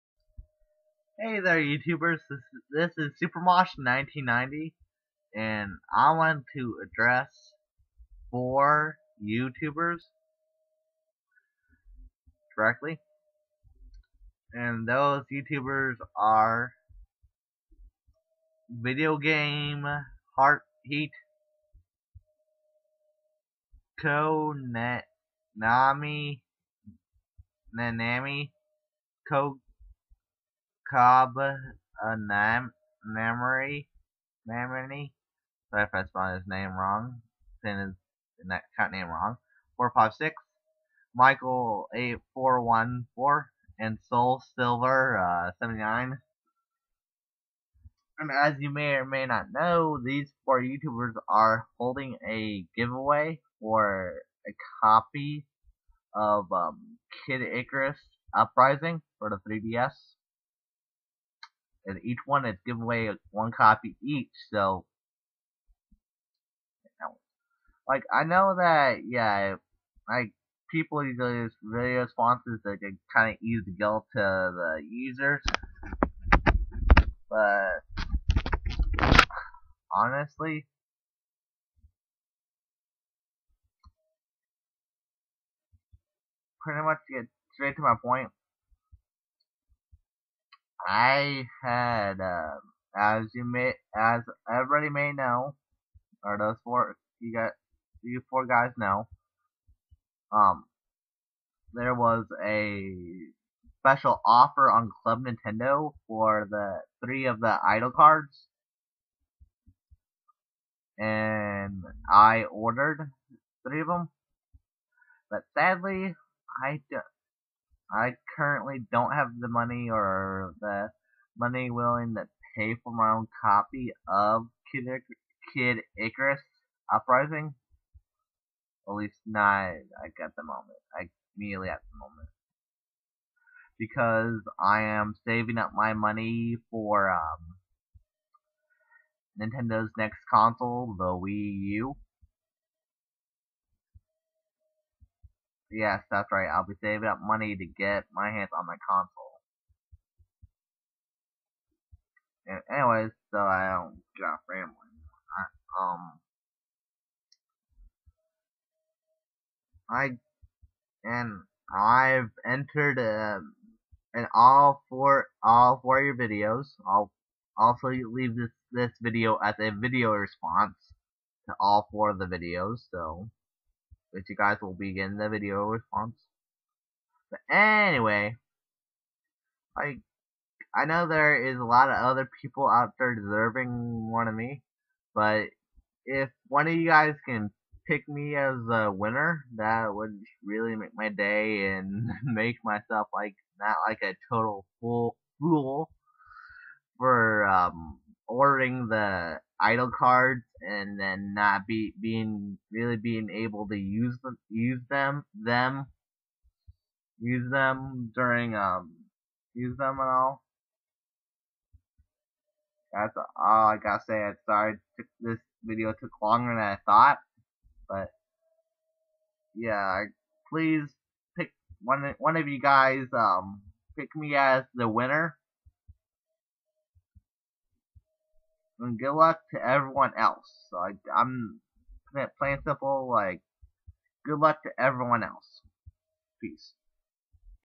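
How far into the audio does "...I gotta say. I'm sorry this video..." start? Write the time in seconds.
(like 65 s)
213 s.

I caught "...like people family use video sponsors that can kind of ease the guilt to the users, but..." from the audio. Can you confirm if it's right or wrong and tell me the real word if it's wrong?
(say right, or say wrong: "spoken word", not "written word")
wrong: "usually", not "family".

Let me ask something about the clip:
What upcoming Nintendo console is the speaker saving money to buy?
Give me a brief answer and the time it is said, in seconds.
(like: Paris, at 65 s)
Wii U, at 141 s.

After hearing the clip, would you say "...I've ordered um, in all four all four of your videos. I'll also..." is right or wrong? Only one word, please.
wrong.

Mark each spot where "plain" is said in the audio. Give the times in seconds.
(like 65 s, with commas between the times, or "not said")
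232 s.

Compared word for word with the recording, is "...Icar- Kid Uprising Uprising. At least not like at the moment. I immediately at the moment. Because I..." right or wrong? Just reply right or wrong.
wrong.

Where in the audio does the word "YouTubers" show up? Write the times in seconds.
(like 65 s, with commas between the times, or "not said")
1 s, 9 s, 15 s, 50 s.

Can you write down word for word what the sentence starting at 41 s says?
Michael eight four one four and Soul Silver uh, seventy nine.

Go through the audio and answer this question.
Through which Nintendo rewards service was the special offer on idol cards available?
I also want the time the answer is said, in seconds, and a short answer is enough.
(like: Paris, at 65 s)
Club Nintendo, at 105 s.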